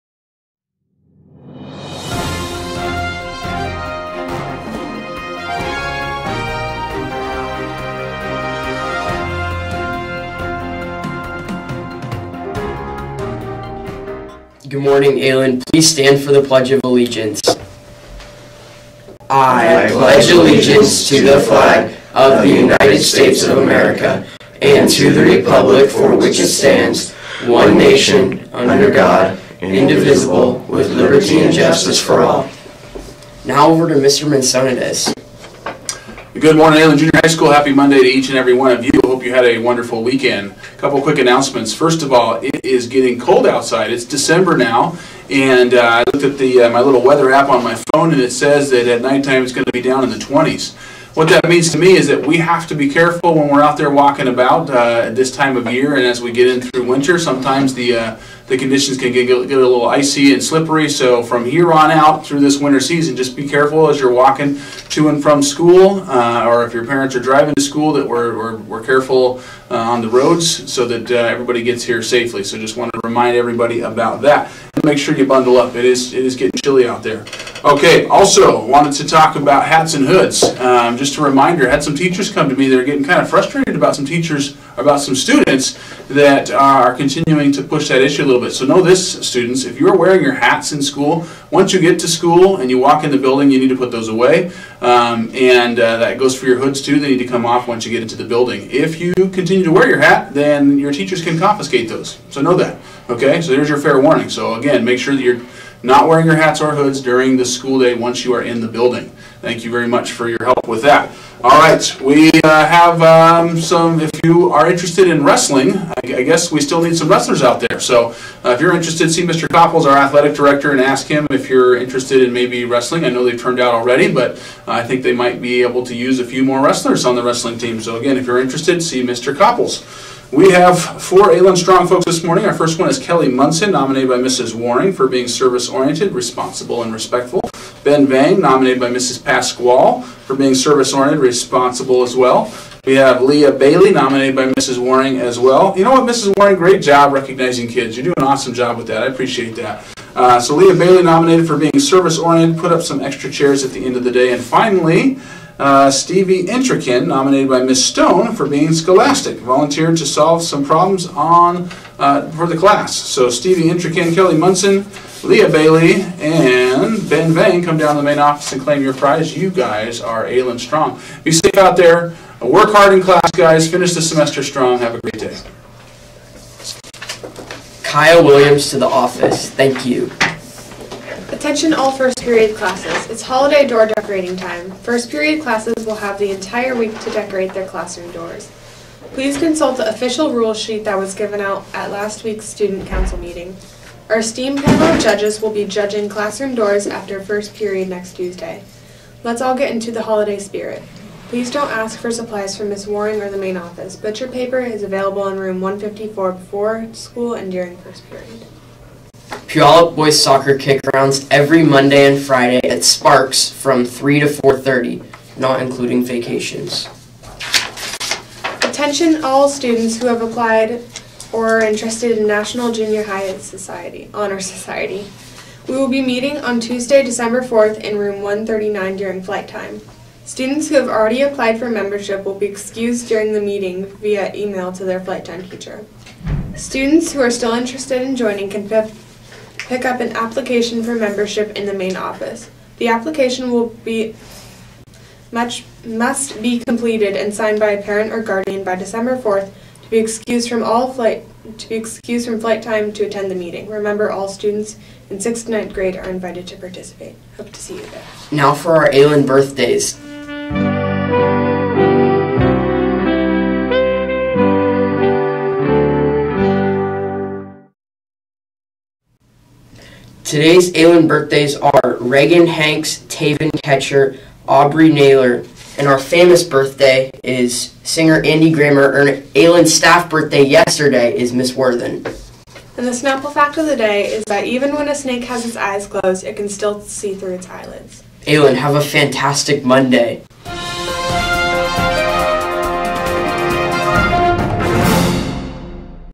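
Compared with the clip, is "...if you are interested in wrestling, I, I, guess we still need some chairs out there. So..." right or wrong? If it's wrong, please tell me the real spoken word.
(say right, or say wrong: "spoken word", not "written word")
wrong: "wrestlers", not "chairs".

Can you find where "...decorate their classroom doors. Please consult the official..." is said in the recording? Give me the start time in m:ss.
3:07.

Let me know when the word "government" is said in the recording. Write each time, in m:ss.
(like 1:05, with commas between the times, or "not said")
not said.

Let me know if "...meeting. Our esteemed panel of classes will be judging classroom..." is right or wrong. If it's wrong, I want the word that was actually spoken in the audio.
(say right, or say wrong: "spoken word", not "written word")
wrong: "judges", not "classes".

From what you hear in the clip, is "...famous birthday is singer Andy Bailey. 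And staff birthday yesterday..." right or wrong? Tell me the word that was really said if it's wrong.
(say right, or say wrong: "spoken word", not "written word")
wrong: "Grammer", not "Bailey".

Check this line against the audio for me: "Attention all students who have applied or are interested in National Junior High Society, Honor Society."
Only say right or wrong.
right.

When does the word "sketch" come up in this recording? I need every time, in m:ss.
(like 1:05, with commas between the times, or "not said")
not said.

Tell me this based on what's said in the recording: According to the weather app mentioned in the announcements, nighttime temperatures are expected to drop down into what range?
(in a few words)
20s.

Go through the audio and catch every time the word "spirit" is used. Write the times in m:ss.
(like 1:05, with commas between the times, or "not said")
3:20.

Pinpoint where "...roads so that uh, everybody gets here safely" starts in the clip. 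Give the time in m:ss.
1:10.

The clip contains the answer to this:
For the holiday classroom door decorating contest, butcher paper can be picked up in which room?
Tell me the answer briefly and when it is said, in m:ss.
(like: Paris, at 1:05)
Room 154, at 3:25.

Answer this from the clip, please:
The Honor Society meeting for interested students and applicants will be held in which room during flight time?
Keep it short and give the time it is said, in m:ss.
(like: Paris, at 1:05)
Room 139, at 3:47.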